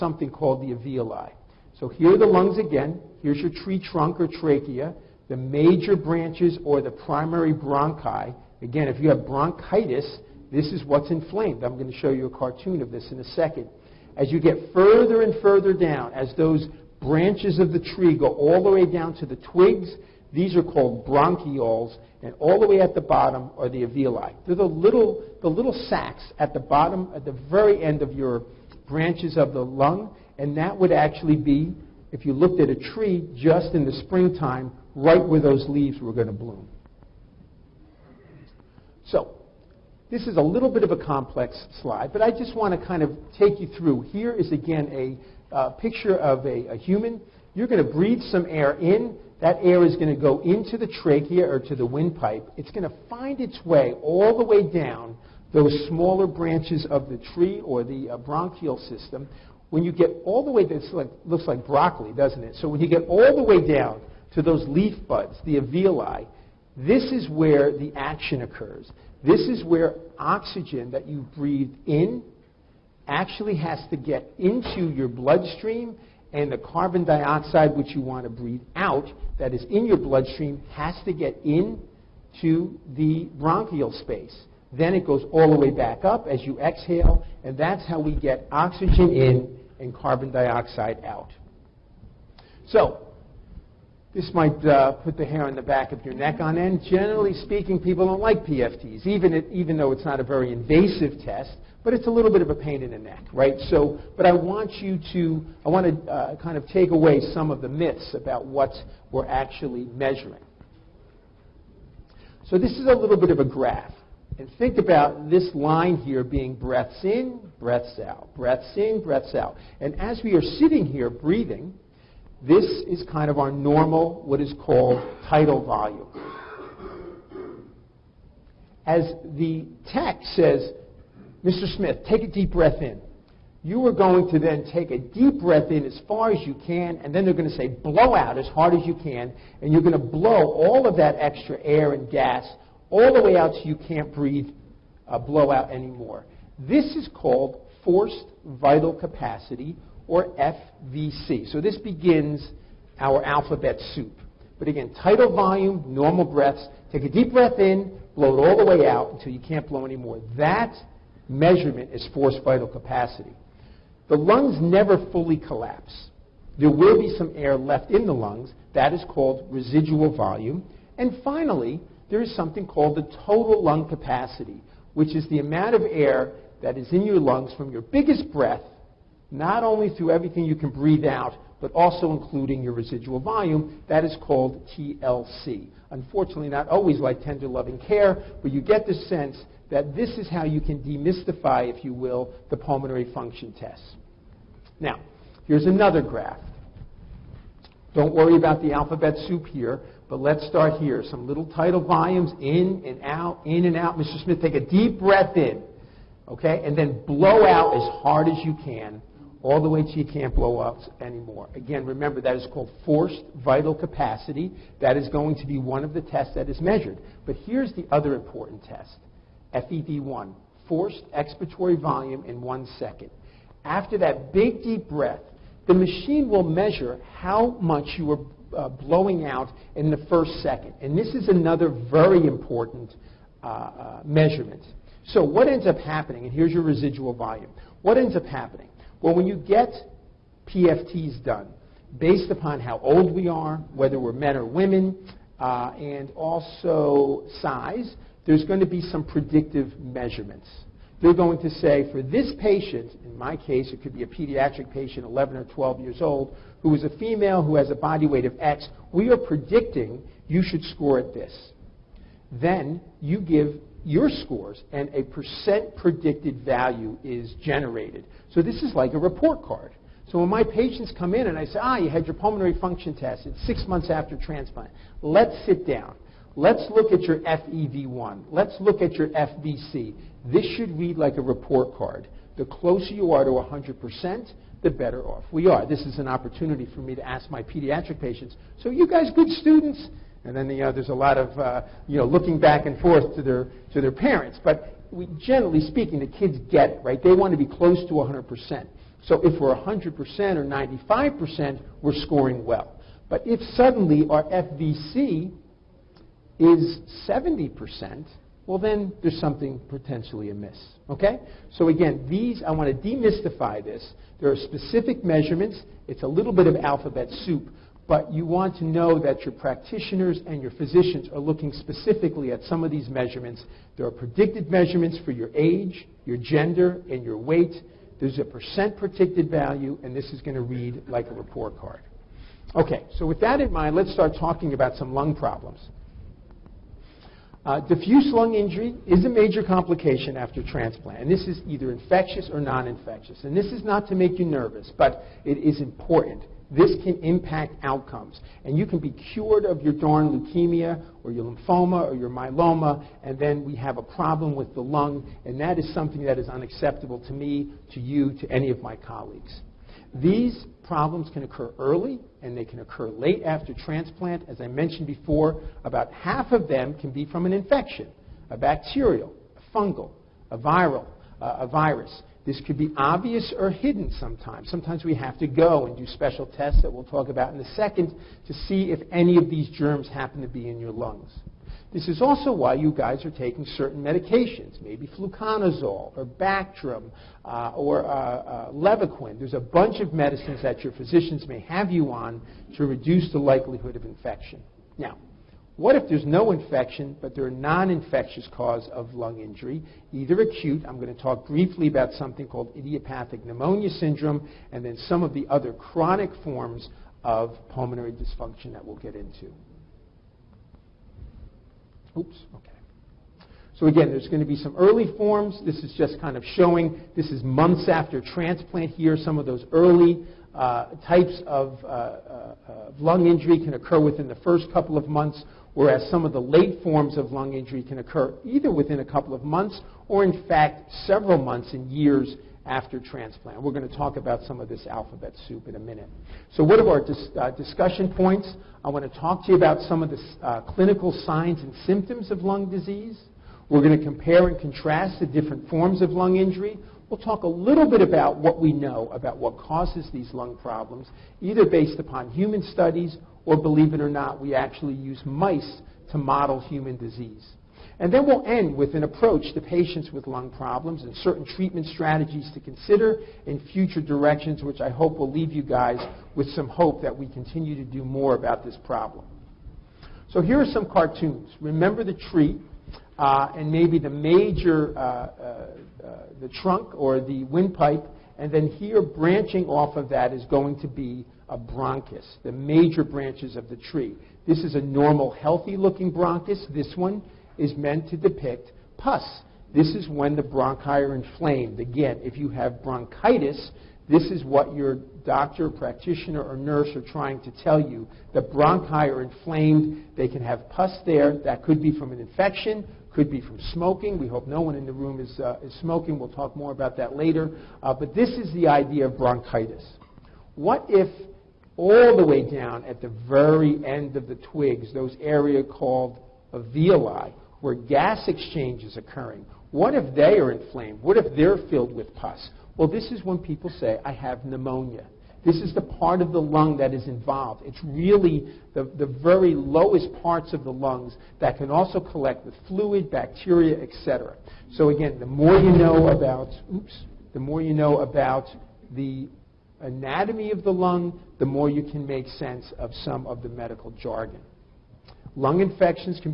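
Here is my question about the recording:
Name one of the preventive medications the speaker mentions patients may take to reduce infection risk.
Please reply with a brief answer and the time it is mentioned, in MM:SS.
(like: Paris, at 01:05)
Fluconazole, at 06:24.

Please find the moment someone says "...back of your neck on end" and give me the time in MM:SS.
01:35.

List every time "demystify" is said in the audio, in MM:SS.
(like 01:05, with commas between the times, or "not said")
03:10, 05:12.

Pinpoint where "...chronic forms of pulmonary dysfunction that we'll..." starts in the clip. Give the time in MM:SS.
06:45.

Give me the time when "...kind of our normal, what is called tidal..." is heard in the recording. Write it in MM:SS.
02:03.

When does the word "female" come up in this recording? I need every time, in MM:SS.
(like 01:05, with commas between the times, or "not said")
04:16.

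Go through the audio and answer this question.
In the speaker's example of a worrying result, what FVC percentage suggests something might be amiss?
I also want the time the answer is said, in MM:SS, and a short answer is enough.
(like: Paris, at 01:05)
70%, at 05:07.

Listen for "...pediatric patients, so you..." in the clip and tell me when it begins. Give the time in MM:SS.
04:47.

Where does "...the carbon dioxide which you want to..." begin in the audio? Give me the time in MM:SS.
01:16.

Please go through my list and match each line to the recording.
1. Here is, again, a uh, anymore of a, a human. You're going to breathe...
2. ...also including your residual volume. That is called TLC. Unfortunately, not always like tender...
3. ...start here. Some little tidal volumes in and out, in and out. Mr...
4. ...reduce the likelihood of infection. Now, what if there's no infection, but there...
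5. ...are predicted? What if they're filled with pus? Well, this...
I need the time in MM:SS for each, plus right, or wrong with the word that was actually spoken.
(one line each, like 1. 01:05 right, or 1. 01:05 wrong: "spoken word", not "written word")
1. 00:44 wrong: "picture", not "anymore"
2. 03:01 right
3. 03:20 right
4. 06:32 right
5. 08:40 wrong: "inflamed", not "predicted".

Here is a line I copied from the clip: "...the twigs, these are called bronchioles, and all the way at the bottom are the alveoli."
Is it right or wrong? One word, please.
right.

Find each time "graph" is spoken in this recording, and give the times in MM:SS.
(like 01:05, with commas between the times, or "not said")
01:53, 03:16.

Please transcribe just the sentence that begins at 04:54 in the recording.
But we, generally speaking, the kids get it, right?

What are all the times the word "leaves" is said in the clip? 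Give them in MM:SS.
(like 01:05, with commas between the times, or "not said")
00:35, 07:45.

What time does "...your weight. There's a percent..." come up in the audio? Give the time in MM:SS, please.
05:27.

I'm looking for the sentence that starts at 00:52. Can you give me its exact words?
It's going to find its way all the way down those smaller branches of the tree or the uh, bronchial system.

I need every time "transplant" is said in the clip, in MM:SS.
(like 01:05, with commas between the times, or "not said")
04:34, 05:40, 06:03, 06:57, 07:12.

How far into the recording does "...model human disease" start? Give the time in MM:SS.
07:35.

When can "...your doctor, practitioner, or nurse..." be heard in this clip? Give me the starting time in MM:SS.
08:14.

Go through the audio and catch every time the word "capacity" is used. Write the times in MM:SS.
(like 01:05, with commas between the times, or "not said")
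02:28, 02:42, 02:53, 03:33.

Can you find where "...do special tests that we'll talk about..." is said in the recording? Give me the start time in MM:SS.
06:15.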